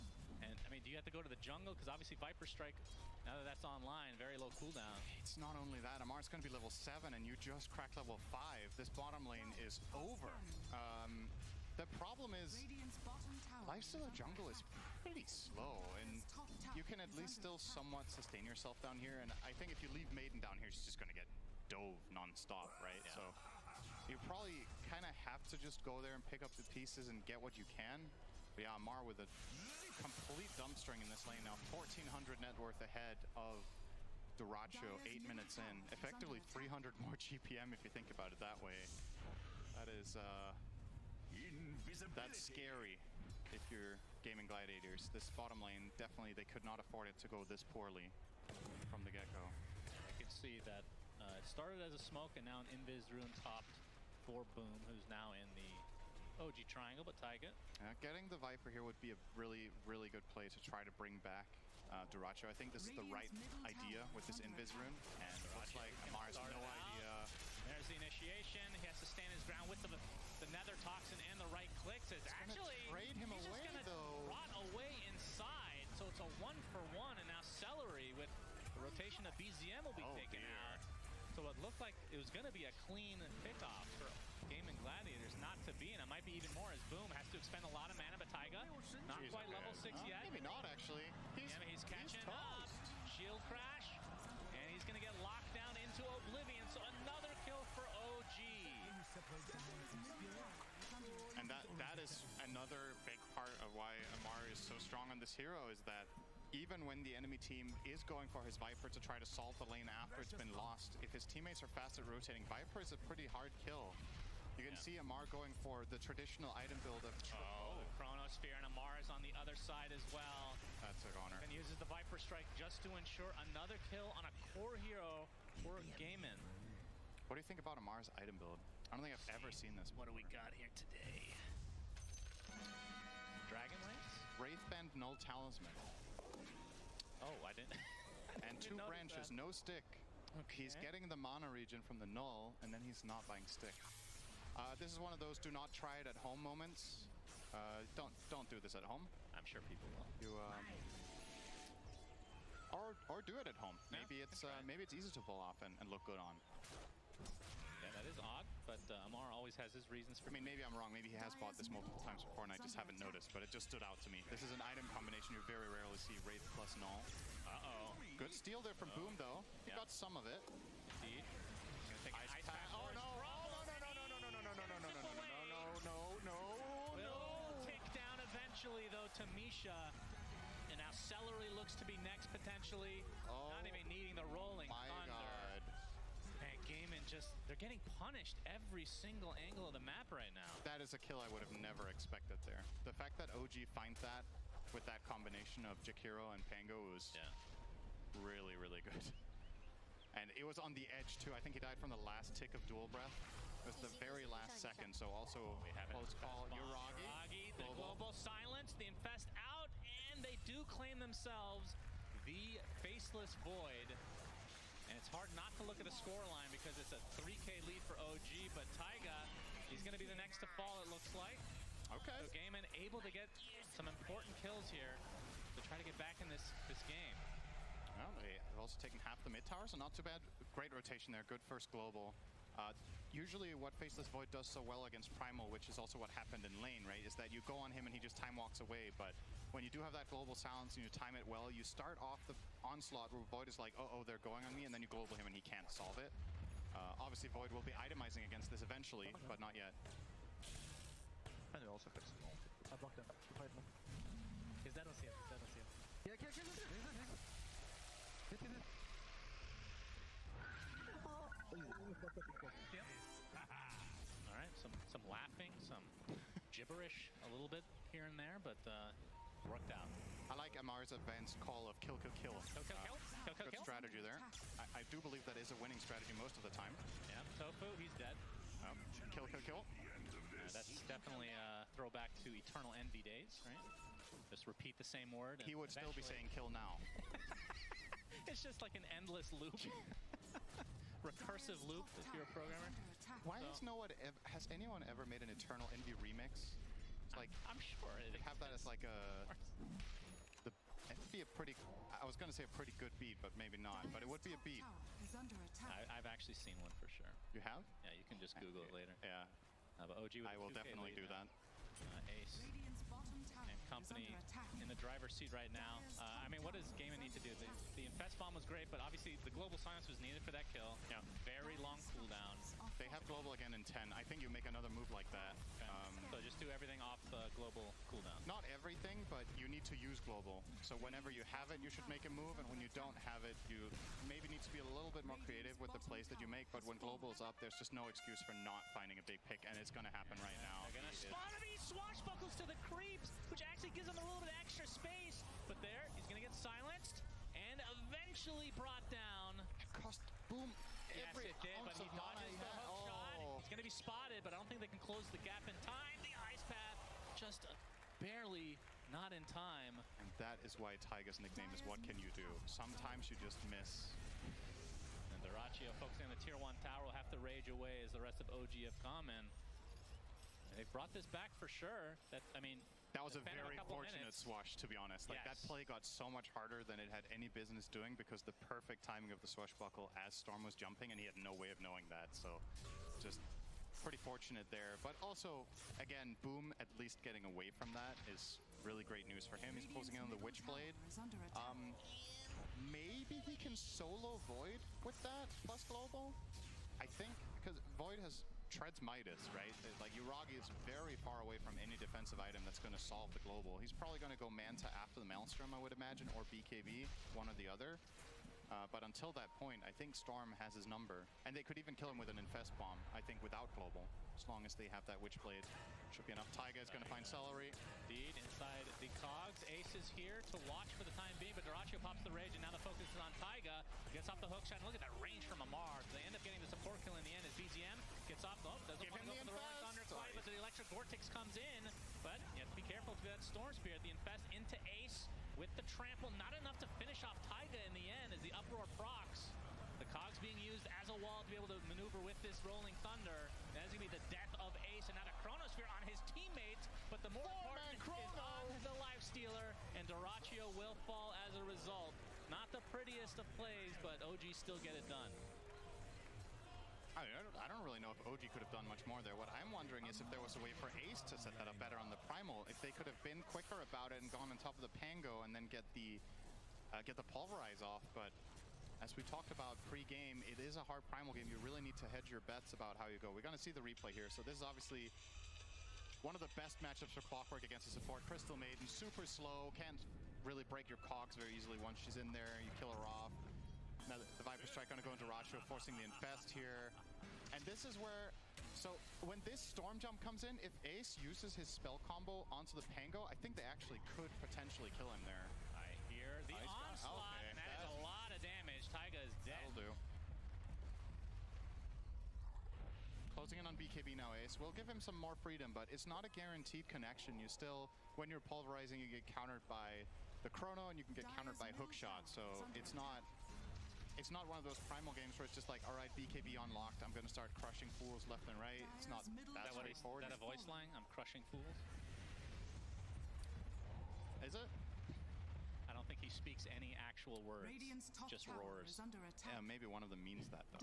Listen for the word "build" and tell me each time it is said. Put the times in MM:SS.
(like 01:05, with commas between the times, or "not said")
01:56, 02:08.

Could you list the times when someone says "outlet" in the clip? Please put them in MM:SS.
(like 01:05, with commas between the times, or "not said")
not said.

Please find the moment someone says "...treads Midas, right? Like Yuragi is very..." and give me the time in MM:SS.
06:38.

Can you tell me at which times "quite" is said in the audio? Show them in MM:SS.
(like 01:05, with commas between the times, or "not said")
01:29, 07:09.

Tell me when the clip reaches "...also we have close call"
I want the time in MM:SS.
03:25.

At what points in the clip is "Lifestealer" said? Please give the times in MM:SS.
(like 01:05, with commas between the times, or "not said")
07:28.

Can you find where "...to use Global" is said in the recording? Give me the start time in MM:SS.
05:29.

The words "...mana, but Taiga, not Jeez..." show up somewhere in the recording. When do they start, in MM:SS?
01:27.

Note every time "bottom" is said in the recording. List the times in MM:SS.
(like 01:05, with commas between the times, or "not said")
00:08, 00:45.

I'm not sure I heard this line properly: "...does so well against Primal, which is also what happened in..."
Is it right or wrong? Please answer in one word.
right.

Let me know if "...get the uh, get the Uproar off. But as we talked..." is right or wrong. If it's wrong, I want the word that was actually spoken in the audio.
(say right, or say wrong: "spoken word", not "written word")
wrong: "Pulverize", not "Uproar".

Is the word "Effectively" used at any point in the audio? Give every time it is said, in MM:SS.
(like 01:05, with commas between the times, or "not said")
00:35.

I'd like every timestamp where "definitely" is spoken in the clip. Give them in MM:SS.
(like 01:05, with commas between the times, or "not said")
00:45, 04:40, 05:10.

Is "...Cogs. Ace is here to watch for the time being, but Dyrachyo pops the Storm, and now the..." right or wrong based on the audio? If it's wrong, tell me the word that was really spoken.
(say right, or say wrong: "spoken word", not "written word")
wrong: "Rage", not "Storm".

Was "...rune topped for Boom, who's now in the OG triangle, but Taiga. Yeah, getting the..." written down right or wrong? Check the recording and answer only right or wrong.
right.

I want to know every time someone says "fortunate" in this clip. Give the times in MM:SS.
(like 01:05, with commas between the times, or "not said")
06:13, 06:23.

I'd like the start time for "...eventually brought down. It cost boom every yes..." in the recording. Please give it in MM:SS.
05:47.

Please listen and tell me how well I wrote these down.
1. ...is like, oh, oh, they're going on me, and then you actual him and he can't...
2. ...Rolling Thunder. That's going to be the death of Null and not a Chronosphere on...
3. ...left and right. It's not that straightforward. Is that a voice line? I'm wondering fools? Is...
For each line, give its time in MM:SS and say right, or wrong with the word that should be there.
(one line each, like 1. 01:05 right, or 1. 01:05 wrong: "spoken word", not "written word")
1. 04:03 wrong: "global", not "actual"
2. 07:22 wrong: "Ace", not "Null"
3. 08:38 wrong: "crushing", not "wondering".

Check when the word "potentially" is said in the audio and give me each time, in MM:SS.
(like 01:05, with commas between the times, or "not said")
03:02, 08:14.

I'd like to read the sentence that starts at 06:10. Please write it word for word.
They brought this back for sure.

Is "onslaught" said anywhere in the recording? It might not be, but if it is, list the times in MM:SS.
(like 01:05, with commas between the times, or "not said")
04:02, 08:16.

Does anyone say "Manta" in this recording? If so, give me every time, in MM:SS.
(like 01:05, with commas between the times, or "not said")
06:44.